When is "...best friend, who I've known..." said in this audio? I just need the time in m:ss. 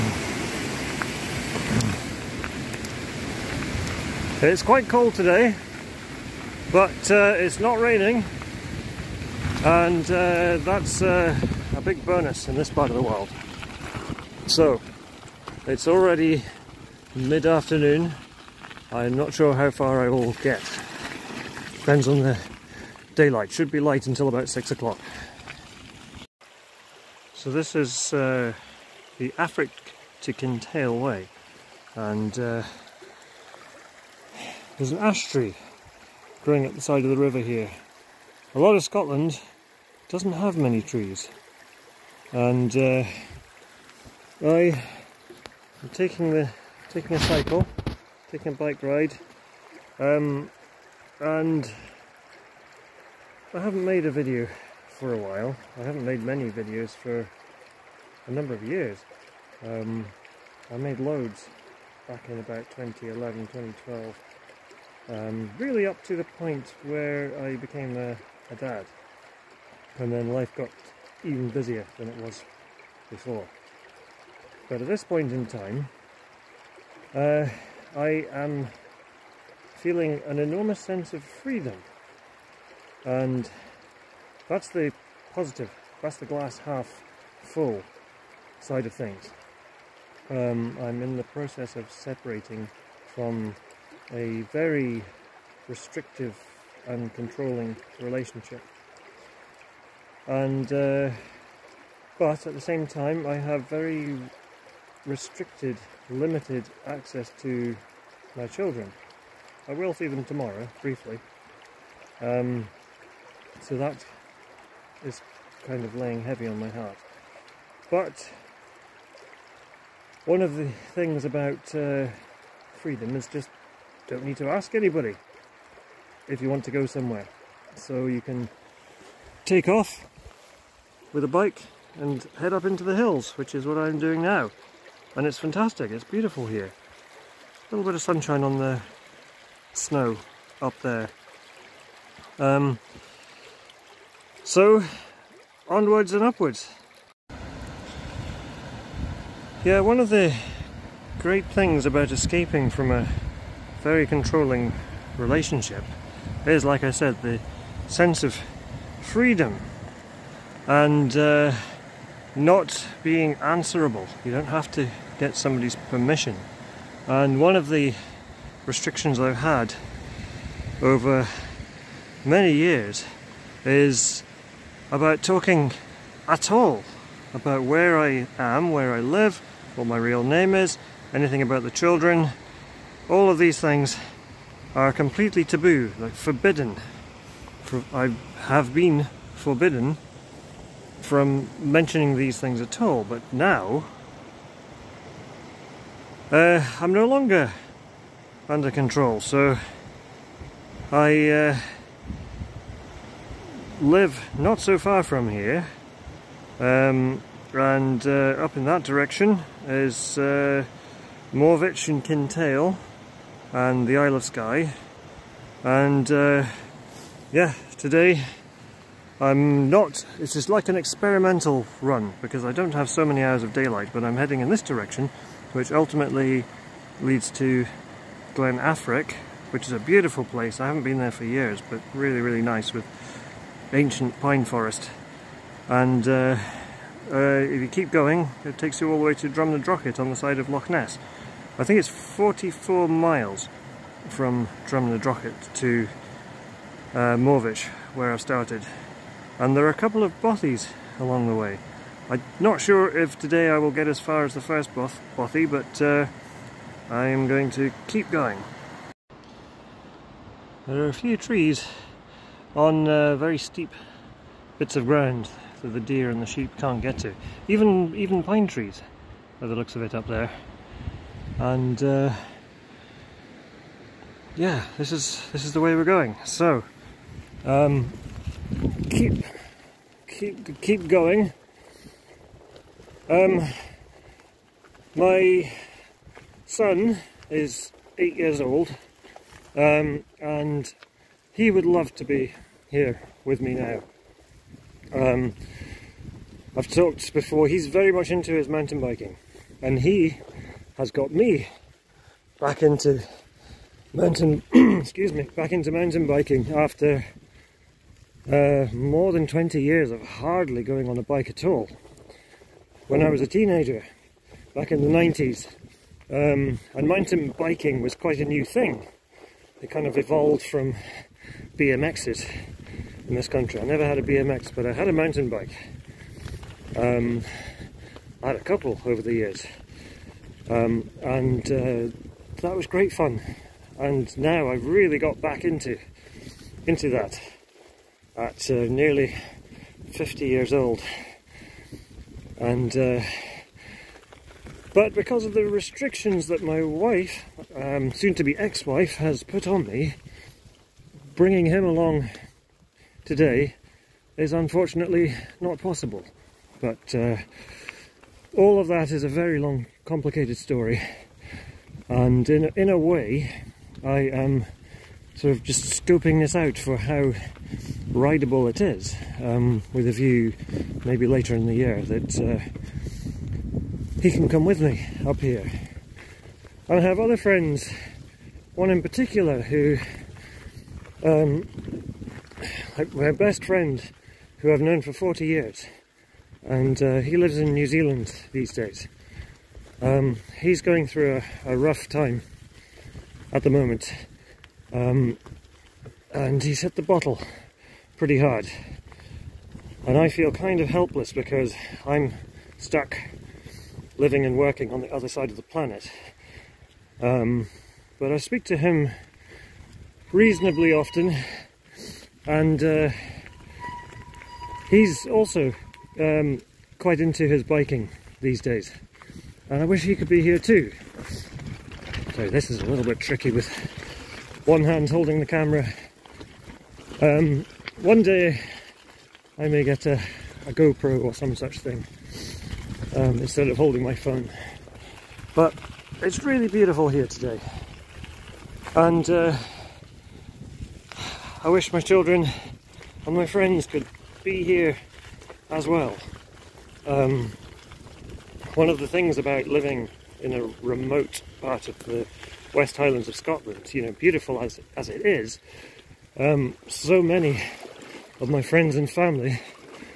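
6:23.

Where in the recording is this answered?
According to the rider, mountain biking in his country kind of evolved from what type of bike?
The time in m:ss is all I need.
5:21.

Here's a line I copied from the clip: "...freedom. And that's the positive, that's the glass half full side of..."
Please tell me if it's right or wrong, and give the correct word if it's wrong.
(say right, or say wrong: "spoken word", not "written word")
right.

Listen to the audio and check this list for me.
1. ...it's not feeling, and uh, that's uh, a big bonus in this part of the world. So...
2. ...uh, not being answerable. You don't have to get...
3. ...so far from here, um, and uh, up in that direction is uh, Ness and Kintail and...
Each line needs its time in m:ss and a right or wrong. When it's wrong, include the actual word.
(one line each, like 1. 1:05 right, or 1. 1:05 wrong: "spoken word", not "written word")
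1. 0:07 wrong: "raining", not "feeling"
2. 2:41 right
3. 3:24 wrong: "Morvich", not "Ness".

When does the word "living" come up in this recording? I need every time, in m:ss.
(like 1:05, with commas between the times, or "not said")
6:43, 7:29.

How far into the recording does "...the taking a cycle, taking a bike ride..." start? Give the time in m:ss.
0:46.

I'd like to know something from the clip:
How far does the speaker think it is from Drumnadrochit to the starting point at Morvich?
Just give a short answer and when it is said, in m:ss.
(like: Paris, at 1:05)
44 miles, at 4:01.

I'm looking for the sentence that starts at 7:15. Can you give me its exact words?
But it's really beautiful here today.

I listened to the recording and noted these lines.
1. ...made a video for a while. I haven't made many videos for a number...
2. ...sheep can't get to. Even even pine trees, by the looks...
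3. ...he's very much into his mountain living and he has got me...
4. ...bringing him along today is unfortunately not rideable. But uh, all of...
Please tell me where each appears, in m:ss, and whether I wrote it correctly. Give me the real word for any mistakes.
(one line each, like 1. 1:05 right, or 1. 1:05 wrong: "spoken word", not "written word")
1. 0:53 right
2. 4:26 right
3. 4:57 wrong: "biking", not "living"
4. 5:51 wrong: "possible", not "rideable".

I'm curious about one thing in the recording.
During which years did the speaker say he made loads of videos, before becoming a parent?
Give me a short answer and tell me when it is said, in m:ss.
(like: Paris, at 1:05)
2011, 2012, at 1:02.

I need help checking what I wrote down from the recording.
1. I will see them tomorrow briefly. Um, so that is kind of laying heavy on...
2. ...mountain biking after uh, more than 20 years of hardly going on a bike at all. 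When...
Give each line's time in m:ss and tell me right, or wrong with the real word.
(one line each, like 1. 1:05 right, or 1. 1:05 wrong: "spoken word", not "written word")
1. 1:49 right
2. 5:05 right.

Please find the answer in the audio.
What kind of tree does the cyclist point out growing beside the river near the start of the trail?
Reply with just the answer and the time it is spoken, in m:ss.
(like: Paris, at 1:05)
Ash, at 0:34.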